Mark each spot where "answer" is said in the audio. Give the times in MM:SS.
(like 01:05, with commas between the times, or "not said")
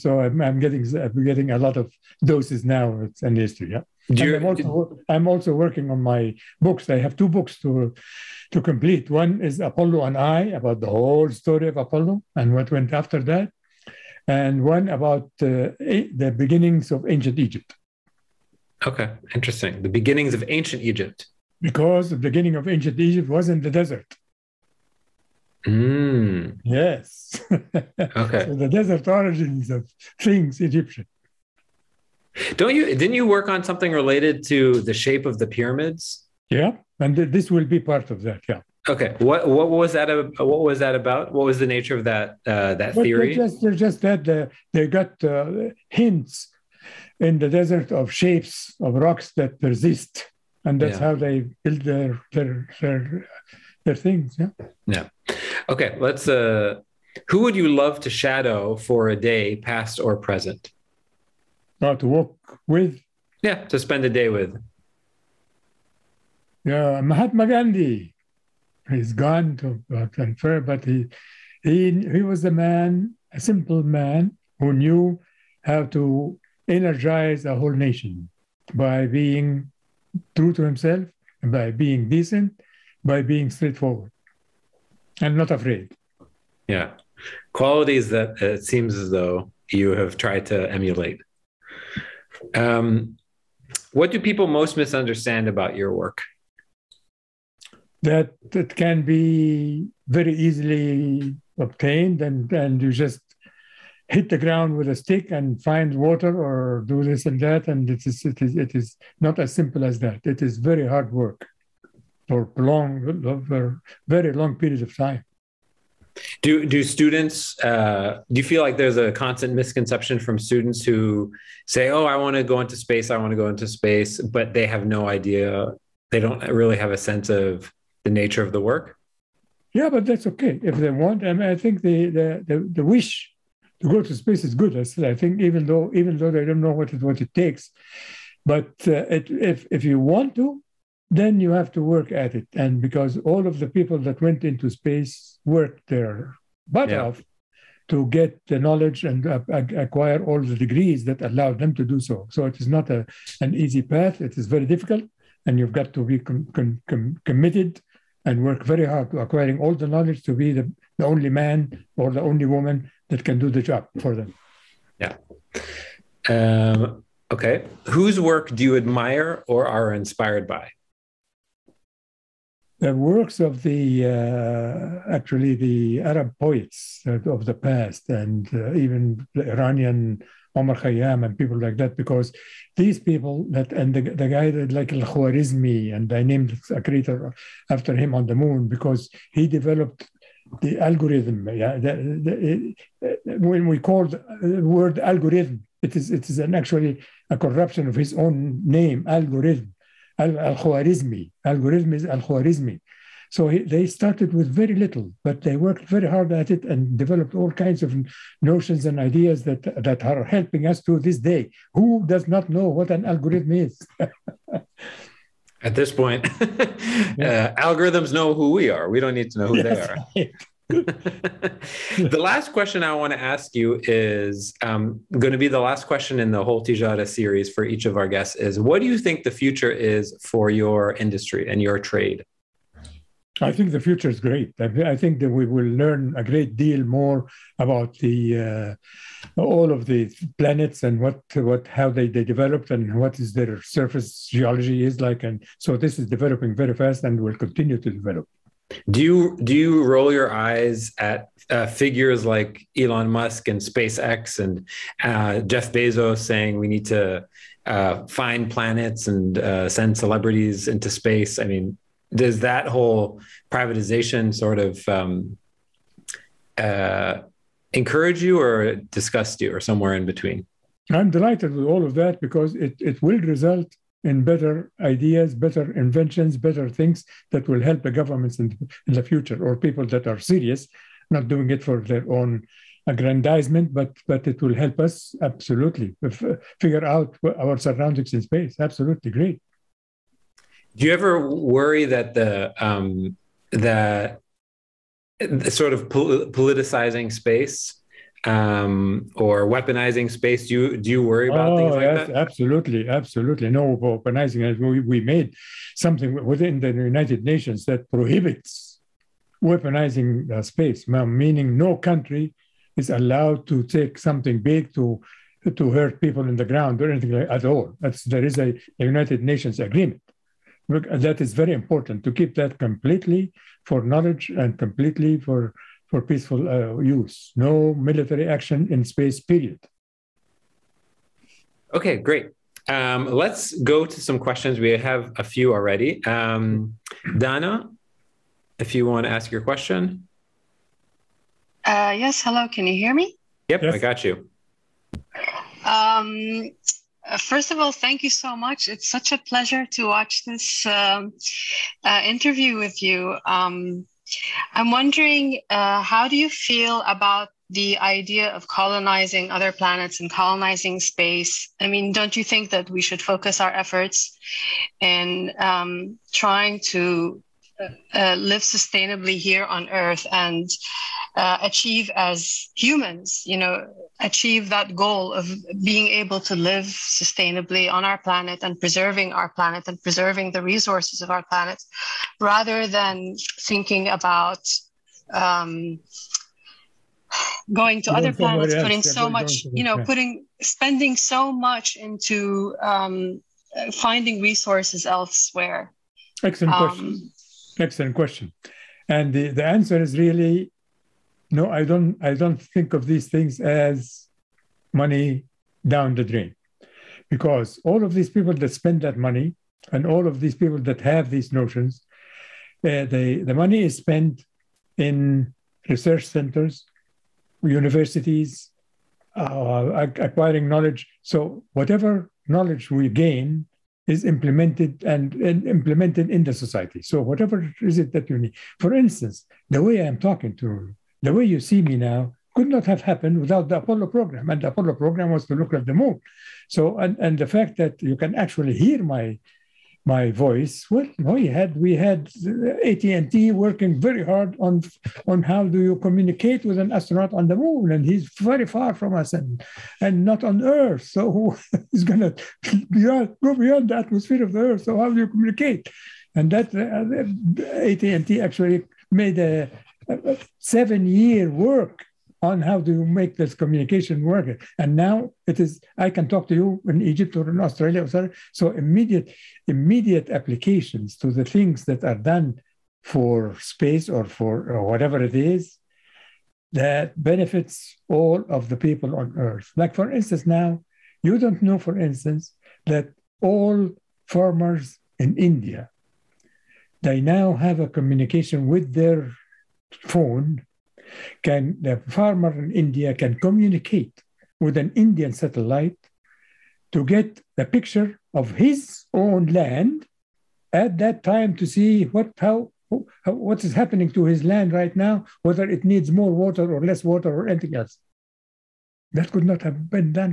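06:39.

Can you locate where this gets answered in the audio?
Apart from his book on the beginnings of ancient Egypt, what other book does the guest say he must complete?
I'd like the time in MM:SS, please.
00:09.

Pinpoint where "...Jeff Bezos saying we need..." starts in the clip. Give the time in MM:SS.
04:15.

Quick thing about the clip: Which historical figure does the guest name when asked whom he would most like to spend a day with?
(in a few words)
Mahatma Gandhi.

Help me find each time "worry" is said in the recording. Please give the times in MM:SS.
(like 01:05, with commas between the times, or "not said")
04:51, 05:01.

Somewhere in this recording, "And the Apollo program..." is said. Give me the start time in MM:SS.
07:14.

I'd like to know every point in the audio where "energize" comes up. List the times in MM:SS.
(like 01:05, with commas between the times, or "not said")
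01:16.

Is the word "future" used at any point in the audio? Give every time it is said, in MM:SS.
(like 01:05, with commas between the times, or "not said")
03:49, 03:53, 04:39.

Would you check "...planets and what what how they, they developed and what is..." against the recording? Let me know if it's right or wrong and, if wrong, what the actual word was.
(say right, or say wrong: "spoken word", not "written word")
right.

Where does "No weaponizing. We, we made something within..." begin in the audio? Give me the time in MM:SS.
05:03.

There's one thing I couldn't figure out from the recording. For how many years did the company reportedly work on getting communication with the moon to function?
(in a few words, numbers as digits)
7.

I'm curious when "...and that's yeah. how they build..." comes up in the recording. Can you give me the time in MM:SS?
00:50.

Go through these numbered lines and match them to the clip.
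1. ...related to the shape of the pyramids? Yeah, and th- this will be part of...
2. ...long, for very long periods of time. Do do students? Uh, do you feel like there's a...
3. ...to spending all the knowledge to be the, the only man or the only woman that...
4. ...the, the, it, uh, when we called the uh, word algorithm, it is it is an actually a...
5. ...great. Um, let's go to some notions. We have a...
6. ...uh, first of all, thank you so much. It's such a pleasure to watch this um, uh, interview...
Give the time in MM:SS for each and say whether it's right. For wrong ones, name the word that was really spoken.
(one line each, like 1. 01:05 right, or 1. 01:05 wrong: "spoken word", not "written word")
1. 00:33 right
2. 01:52 right
3. 02:39 wrong: "acquiring", not "spending"
4. 03:11 right
5. 05:31 wrong: "questions", not "notions"
6. 05:47 right.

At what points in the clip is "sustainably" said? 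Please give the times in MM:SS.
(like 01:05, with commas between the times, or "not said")
06:08, 06:16.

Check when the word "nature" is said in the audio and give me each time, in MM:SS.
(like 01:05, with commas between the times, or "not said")
00:41, 02:08.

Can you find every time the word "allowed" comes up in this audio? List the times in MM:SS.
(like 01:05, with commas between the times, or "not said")
02:31, 05:12.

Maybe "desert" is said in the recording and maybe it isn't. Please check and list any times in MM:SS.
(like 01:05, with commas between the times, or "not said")
00:23, 00:28, 00:47.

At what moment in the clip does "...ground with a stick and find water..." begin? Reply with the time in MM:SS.
01:44.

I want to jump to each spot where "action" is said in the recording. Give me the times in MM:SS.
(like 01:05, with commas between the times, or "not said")
05:28.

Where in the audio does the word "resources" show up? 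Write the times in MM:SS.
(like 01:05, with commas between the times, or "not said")
06:20, 06:34.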